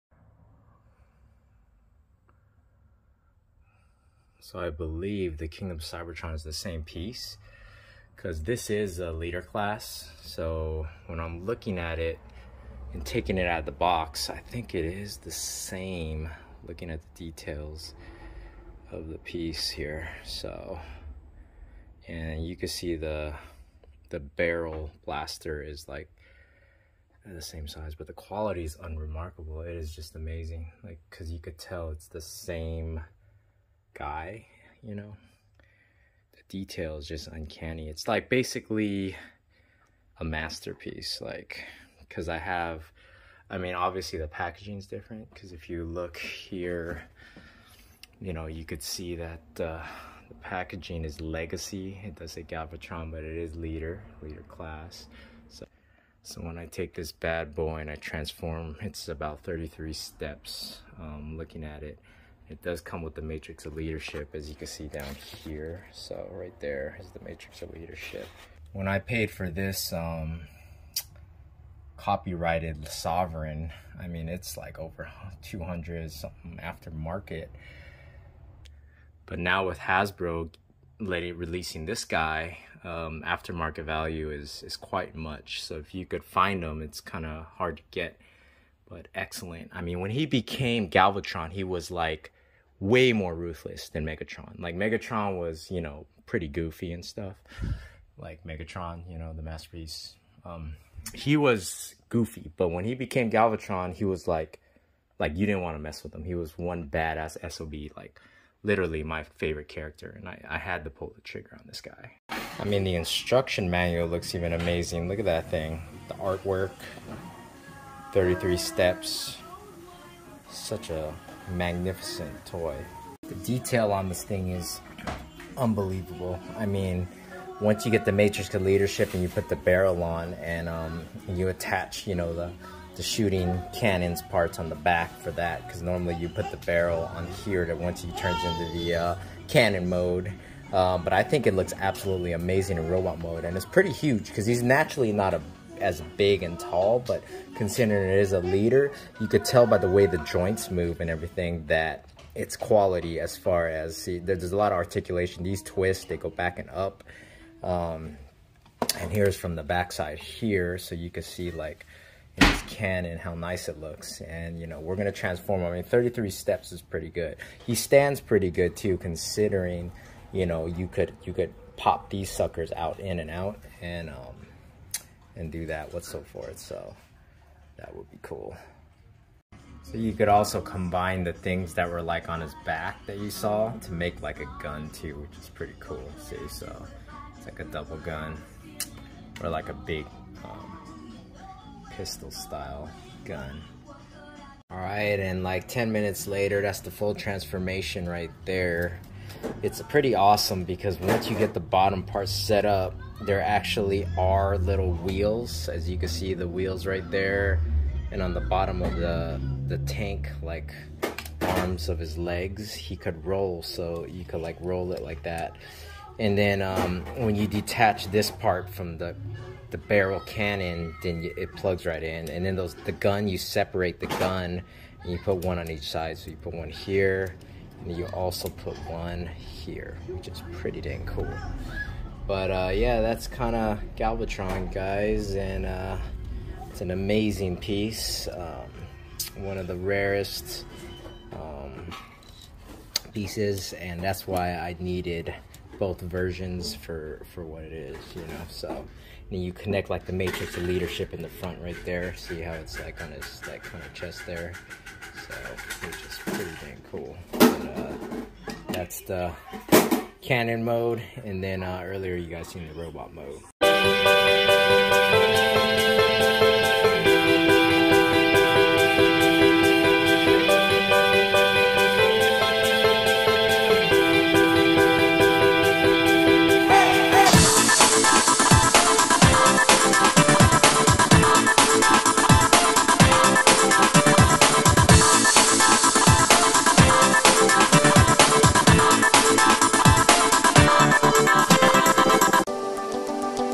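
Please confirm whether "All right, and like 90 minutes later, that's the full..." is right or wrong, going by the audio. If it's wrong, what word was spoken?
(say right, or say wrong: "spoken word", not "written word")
wrong: "10", not "90".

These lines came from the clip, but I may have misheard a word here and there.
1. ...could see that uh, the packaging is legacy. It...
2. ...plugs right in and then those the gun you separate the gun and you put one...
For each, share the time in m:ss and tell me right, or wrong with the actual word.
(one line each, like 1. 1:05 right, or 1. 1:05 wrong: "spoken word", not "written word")
1. 0:48 right
2. 3:41 right.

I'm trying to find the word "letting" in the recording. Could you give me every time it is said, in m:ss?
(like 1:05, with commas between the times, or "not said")
1:20.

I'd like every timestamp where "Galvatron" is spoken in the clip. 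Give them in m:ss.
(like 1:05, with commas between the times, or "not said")
0:52, 1:30, 1:43, 3:53.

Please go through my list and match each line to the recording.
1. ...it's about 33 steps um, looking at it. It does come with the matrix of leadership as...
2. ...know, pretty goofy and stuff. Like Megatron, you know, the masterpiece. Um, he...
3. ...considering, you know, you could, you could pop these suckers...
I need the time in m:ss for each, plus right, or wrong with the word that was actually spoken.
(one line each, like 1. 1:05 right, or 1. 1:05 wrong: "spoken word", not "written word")
1. 0:58 right
2. 1:35 right
3. 2:48 right.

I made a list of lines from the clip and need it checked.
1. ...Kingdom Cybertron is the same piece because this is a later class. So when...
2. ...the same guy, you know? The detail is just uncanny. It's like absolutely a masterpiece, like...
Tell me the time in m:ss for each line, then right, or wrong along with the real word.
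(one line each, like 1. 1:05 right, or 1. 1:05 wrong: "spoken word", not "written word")
1. 0:05 wrong: "leader", not "later"
2. 0:32 wrong: "basically", not "absolutely".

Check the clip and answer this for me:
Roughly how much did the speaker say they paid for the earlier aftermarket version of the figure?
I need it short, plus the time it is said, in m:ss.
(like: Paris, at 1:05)
Over 200, at 1:14.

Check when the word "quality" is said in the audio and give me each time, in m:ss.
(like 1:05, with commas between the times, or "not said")
0:28, 2:32.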